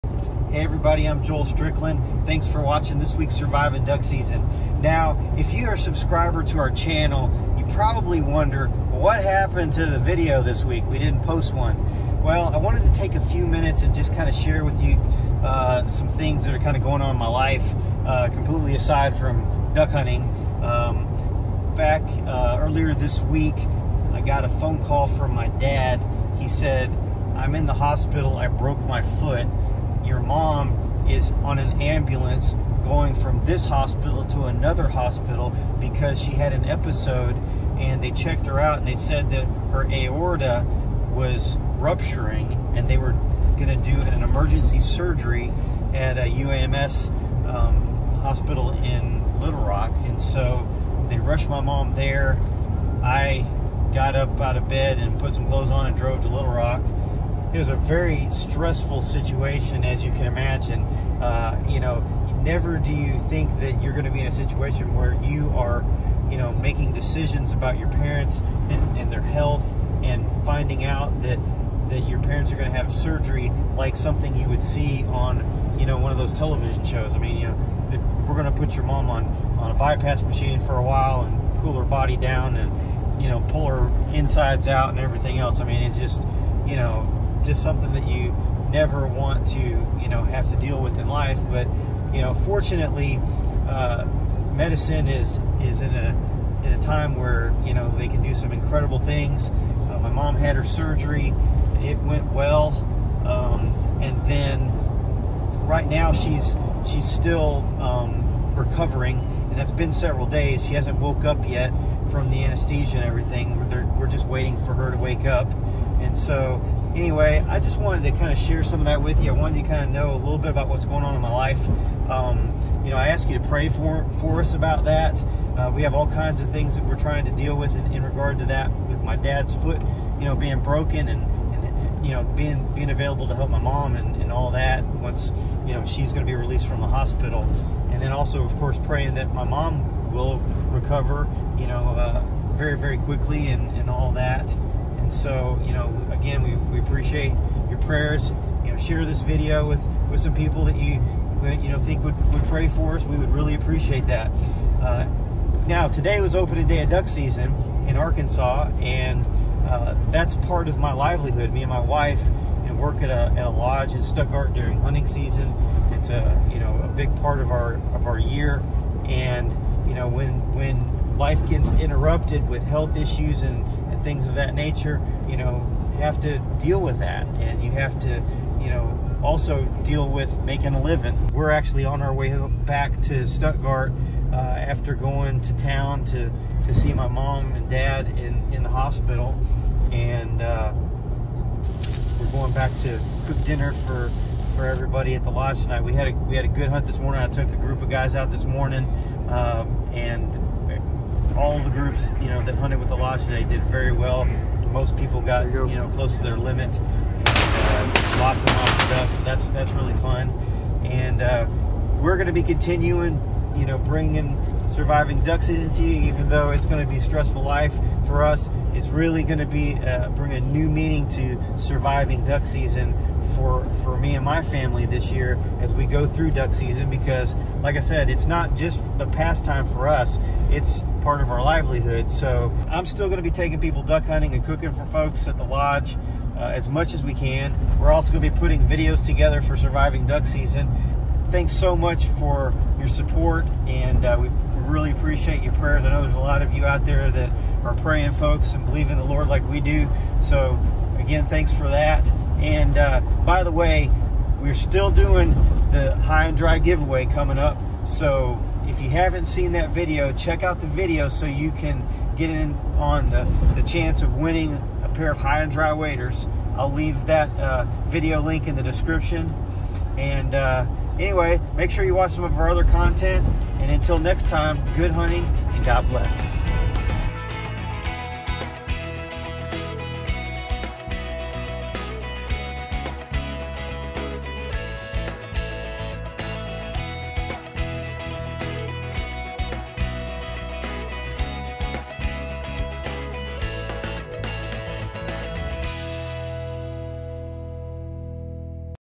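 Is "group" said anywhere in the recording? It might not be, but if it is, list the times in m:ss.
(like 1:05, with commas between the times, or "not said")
3:17, 3:21.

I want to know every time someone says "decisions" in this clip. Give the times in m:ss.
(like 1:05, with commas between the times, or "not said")
1:06.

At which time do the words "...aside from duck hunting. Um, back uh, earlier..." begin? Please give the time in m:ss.
0:18.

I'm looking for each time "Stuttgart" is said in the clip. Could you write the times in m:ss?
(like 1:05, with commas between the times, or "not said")
2:44, 3:03.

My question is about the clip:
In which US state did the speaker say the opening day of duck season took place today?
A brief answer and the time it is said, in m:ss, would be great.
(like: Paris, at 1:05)
Arkansas, at 2:37.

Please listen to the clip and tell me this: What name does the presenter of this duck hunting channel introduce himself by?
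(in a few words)
Joel Strickland.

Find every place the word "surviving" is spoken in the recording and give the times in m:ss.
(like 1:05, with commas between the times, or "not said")
0:03, 3:34, 3:41, 3:59.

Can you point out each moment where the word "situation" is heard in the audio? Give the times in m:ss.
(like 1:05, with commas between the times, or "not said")
0:59, 1:04.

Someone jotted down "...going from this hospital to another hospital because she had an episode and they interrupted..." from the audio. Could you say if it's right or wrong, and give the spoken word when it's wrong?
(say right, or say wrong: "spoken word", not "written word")
wrong: "checked", not "interrupted".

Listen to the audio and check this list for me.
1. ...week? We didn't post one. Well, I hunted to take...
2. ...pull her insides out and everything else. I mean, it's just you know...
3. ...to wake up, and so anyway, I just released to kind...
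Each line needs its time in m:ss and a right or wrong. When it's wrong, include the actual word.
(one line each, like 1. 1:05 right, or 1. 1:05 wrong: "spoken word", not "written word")
1. 0:10 wrong: "wanted", not "hunted"
2. 1:23 right
3. 1:54 wrong: "wanted", not "released".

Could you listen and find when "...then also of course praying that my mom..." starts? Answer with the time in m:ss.
2:18.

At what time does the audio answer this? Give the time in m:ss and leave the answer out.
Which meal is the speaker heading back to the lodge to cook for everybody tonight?
3:13.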